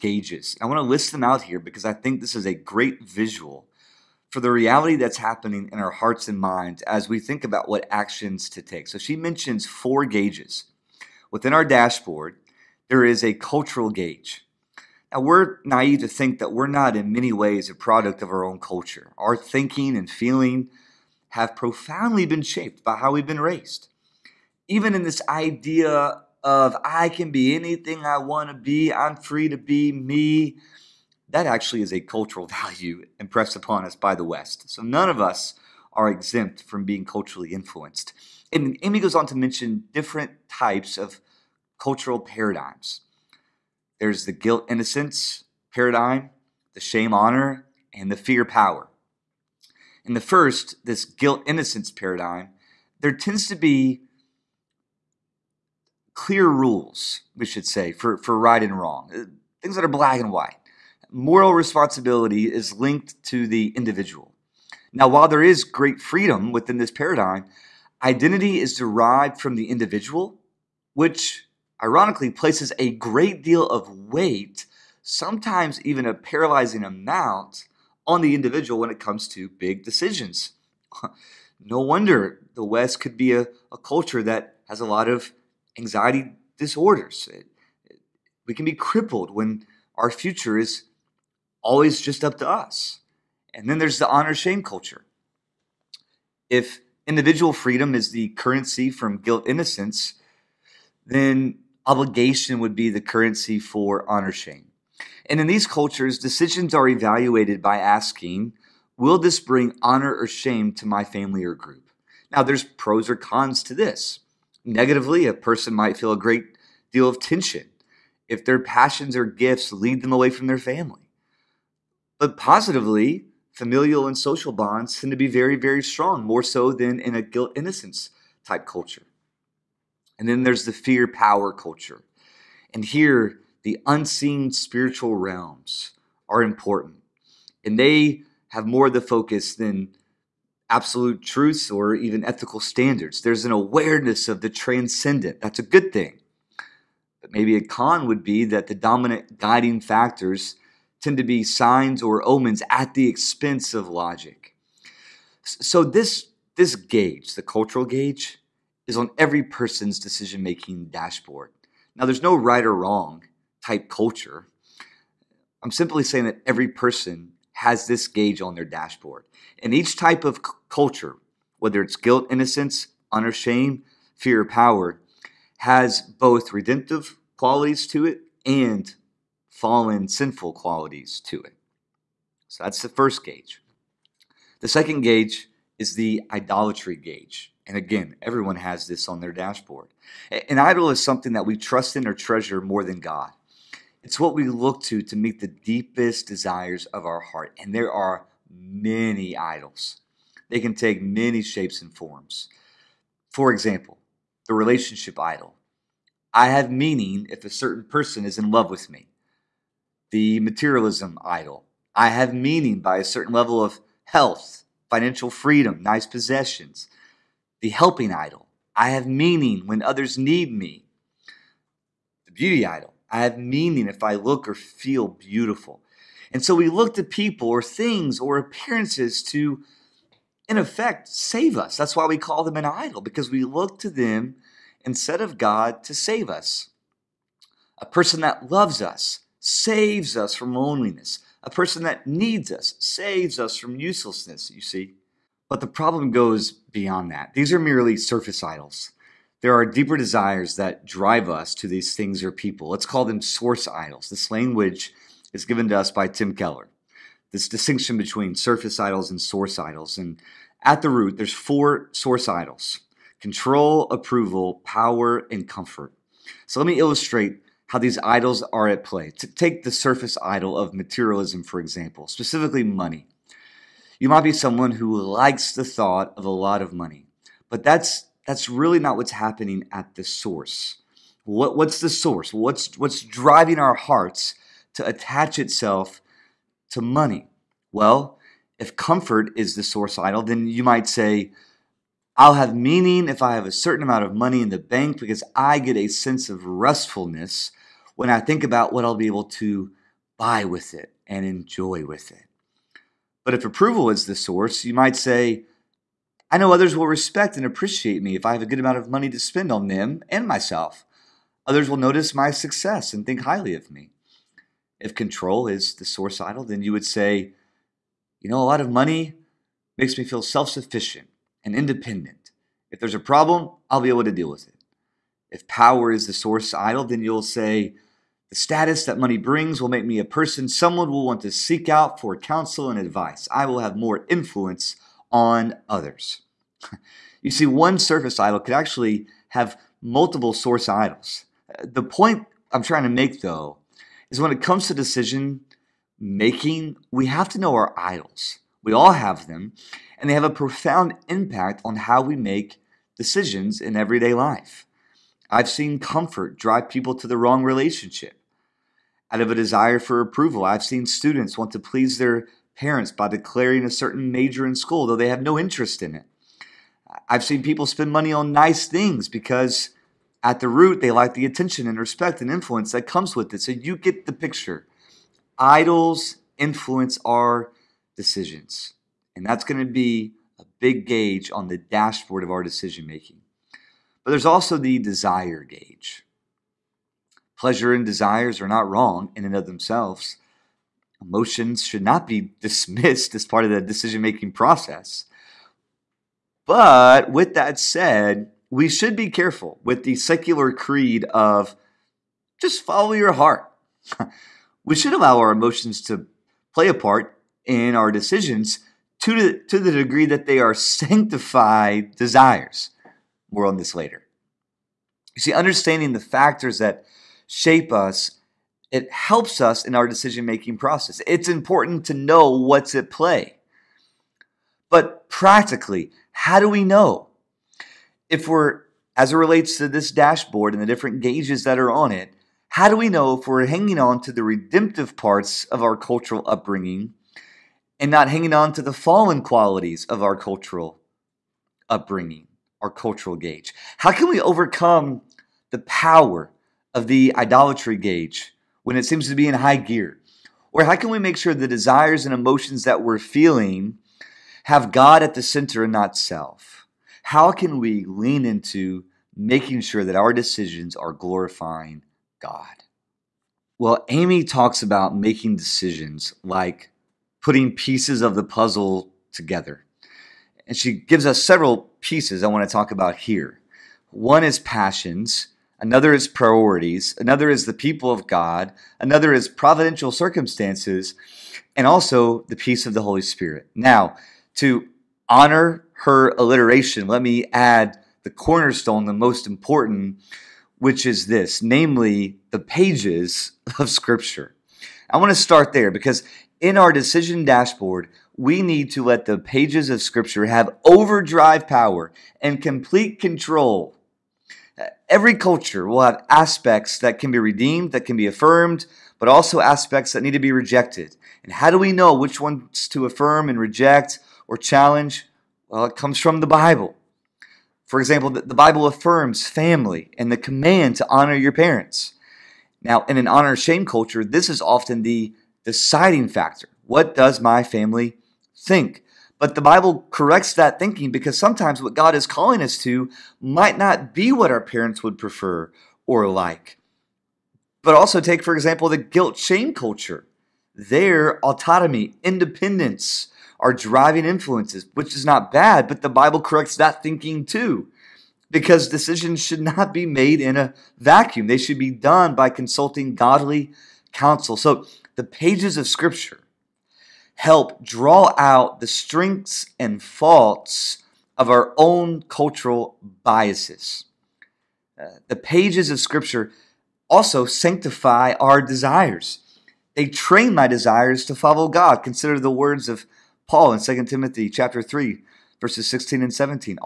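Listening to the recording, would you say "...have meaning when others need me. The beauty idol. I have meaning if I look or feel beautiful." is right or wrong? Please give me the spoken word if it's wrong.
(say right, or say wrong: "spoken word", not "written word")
right.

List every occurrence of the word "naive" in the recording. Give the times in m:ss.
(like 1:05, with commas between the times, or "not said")
0:15.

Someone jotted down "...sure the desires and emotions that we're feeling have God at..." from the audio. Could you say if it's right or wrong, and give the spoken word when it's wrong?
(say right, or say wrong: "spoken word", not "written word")
right.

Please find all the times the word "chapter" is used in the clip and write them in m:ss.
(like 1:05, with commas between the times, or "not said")
9:34.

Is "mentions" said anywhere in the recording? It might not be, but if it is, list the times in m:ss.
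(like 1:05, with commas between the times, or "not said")
0:09, 0:39.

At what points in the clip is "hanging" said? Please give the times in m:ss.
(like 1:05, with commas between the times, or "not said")
7:13, 7:18.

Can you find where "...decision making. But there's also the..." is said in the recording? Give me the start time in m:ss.
6:22.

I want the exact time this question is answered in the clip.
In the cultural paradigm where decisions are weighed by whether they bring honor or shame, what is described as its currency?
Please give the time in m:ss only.
1:41.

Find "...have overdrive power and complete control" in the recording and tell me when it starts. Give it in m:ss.
8:20.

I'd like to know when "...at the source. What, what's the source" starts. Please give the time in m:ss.
4:39.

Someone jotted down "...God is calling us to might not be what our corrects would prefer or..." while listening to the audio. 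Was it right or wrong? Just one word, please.
wrong.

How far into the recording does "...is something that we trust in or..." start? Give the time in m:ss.
3:10.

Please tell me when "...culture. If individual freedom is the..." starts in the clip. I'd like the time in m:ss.
1:34.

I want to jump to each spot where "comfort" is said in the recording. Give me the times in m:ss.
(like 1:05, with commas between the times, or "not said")
4:25, 4:48, 5:55.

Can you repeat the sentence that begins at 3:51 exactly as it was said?
That's why we call them an idol, because we look to them instead of God to save us.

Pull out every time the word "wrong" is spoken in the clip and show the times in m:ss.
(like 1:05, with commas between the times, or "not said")
0:58, 2:42, 5:57, 6:28.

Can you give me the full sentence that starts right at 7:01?
It's important to know what's at play.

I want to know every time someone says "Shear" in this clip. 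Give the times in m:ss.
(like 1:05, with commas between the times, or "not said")
not said.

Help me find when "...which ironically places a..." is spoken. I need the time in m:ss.
1:10.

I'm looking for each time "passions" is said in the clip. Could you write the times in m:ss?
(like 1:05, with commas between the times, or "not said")
1:58, 7:54.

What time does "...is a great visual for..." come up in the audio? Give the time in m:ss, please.
0:02.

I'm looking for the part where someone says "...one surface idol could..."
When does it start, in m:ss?
5:37.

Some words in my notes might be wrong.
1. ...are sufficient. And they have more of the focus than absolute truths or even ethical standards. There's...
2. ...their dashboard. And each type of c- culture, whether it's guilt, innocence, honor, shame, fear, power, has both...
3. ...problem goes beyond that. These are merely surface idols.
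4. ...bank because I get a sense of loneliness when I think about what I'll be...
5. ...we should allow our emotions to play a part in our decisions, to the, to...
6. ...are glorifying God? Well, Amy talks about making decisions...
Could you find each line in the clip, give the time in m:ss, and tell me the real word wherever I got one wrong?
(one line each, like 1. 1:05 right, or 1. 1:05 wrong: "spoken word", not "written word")
1. 2:16 wrong: "important", not "sufficient"
2. 2:48 right
3. 4:05 right
4. 4:54 wrong: "restfulness", not "loneliness"
5. 6:44 right
6. 7:40 right.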